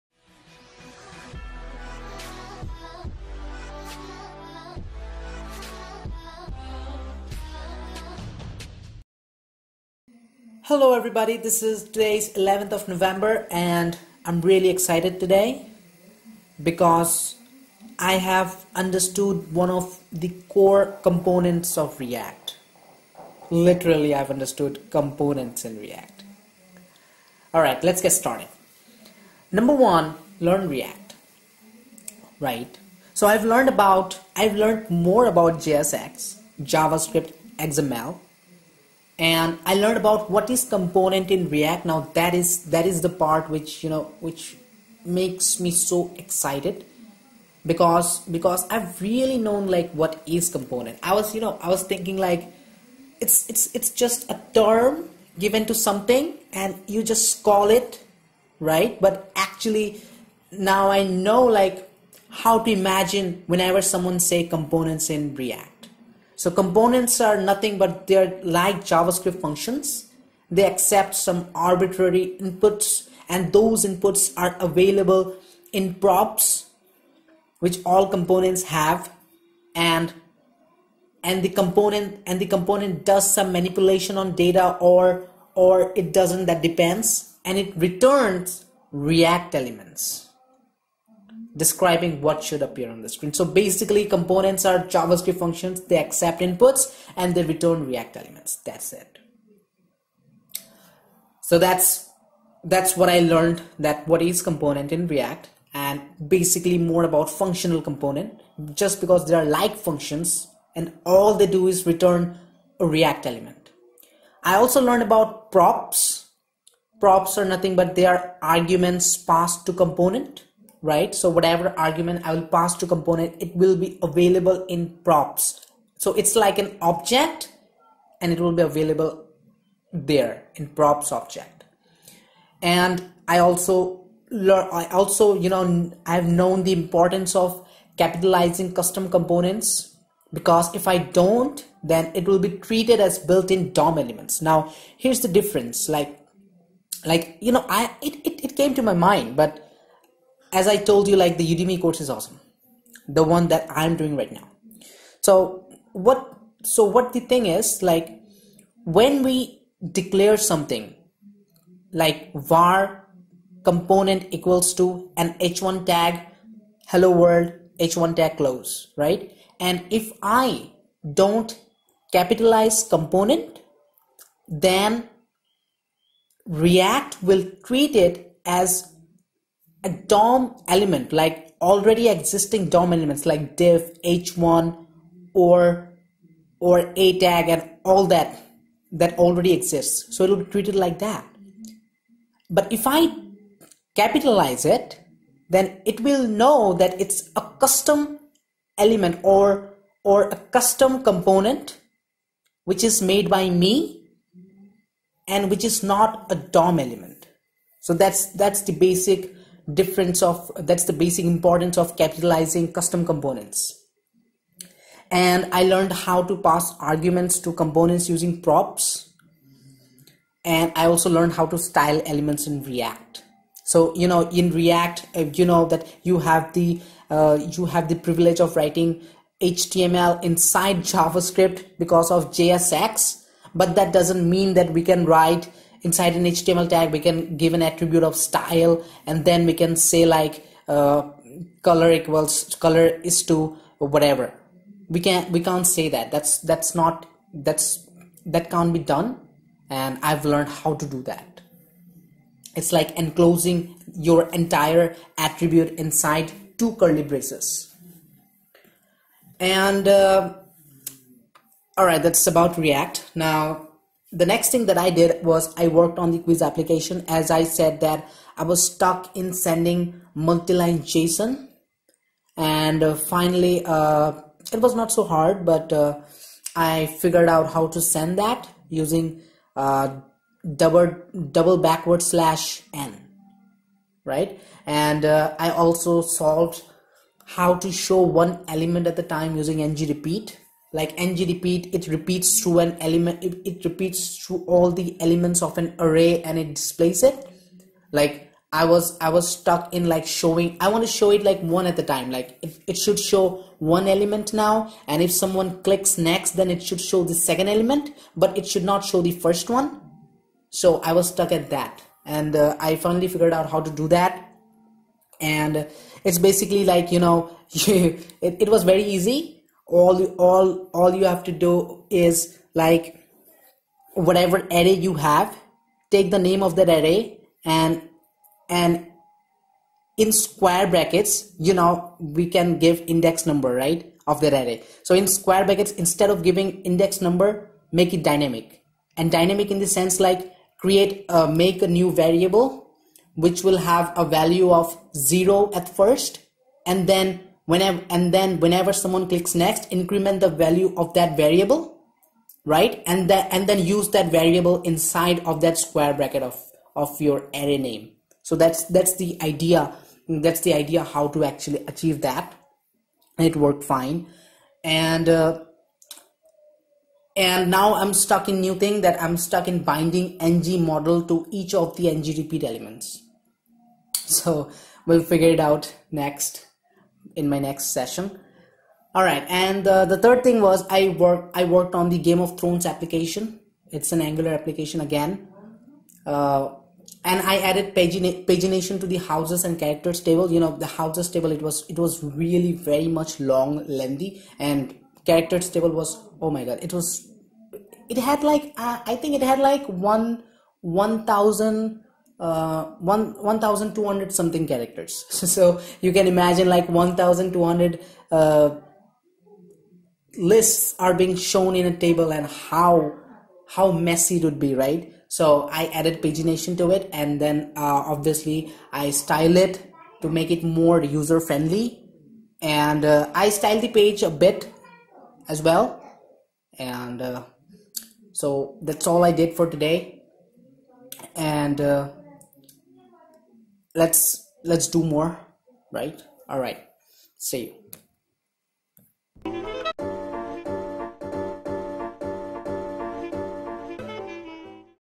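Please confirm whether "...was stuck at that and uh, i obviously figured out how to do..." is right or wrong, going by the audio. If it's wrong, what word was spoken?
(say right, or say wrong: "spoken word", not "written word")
wrong: "finally", not "obviously".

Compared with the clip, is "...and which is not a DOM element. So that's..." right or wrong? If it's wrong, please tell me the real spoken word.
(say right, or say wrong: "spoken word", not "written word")
right.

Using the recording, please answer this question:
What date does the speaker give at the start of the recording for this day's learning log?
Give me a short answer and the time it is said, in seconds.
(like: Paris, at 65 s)
11th of November, at 12 s.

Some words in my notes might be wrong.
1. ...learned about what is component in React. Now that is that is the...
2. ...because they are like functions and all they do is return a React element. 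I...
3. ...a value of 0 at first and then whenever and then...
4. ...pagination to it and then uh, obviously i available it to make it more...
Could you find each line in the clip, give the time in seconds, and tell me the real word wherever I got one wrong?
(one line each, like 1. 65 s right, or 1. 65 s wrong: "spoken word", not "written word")
1. 39 s right
2. 109 s right
3. 343 s right
4. 416 s wrong: "style", not "available".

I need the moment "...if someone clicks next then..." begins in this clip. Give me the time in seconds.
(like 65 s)
305 s.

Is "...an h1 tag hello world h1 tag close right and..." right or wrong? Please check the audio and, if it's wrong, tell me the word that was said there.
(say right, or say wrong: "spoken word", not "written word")
right.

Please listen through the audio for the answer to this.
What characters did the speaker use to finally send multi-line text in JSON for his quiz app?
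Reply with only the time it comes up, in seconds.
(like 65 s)
280 s.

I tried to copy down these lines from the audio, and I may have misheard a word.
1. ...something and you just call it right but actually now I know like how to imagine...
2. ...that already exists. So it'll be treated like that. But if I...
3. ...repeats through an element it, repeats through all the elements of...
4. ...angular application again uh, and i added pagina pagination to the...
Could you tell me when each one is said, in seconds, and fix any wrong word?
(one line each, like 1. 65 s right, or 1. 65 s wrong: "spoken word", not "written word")
1. 55 s right
2. 188 s right
3. 291 s right
4. 384 s right.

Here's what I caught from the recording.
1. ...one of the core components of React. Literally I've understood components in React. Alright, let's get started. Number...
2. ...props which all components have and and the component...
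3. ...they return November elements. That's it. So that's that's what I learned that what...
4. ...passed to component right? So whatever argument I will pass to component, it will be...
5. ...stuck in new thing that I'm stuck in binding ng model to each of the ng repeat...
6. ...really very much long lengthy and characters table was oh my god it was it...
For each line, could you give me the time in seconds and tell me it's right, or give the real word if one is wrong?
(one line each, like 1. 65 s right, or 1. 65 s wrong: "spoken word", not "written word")
1. 19 s right
2. 75 s right
3. 97 s wrong: "React", not "November"
4. 119 s right
5. 367 s right
6. 392 s right.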